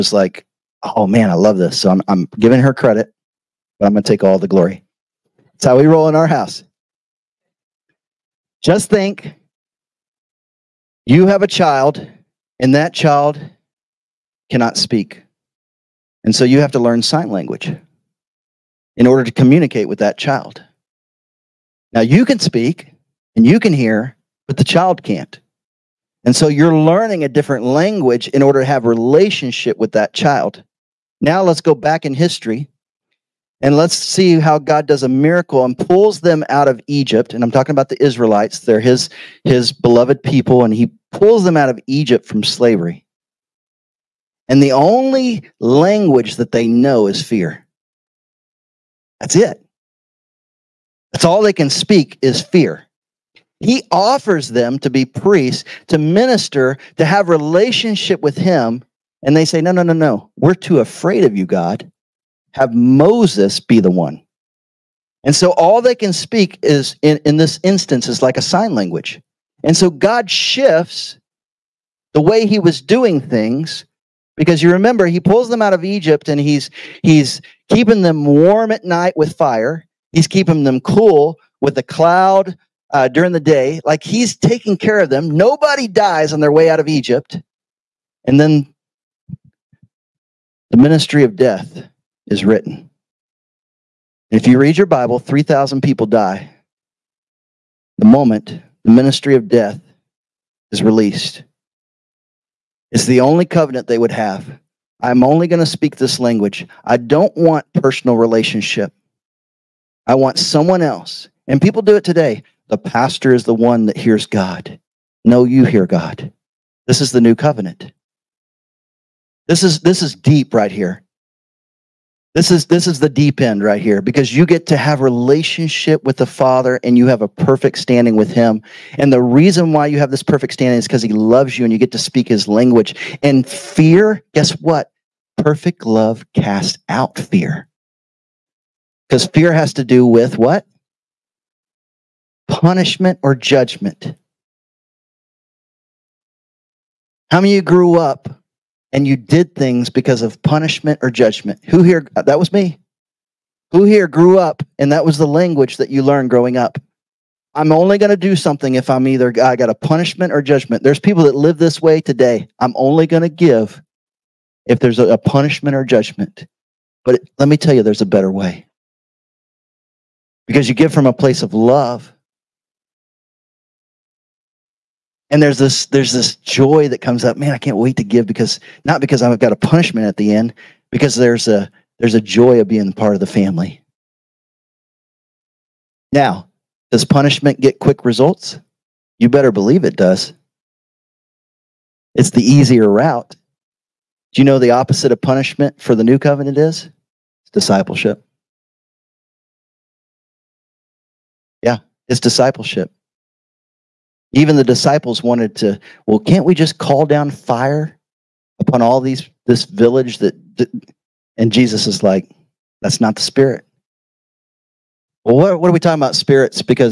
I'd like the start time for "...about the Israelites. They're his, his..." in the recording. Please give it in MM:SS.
00:37.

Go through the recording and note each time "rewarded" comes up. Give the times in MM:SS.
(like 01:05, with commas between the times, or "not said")
not said.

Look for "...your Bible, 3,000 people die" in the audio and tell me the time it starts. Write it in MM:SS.
01:34.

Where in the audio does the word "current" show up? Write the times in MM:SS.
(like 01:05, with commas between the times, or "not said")
not said.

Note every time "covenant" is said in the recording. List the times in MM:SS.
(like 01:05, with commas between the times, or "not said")
01:43, 01:57, 03:16.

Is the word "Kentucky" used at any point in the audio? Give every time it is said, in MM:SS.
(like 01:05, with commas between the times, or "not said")
not said.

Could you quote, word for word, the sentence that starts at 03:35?
Well, what, what are we talking about spirits?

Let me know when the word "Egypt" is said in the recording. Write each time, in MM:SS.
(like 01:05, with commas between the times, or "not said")
00:36, 00:41, 01:15, 01:26.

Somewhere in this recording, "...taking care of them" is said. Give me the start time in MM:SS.
01:24.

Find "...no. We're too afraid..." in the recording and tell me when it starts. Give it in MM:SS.
00:59.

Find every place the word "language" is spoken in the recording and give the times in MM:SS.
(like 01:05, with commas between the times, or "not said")
00:17, 00:27, 00:45, 01:08, 01:46, 02:12, 02:35.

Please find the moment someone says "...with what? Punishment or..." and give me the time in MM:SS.
02:20.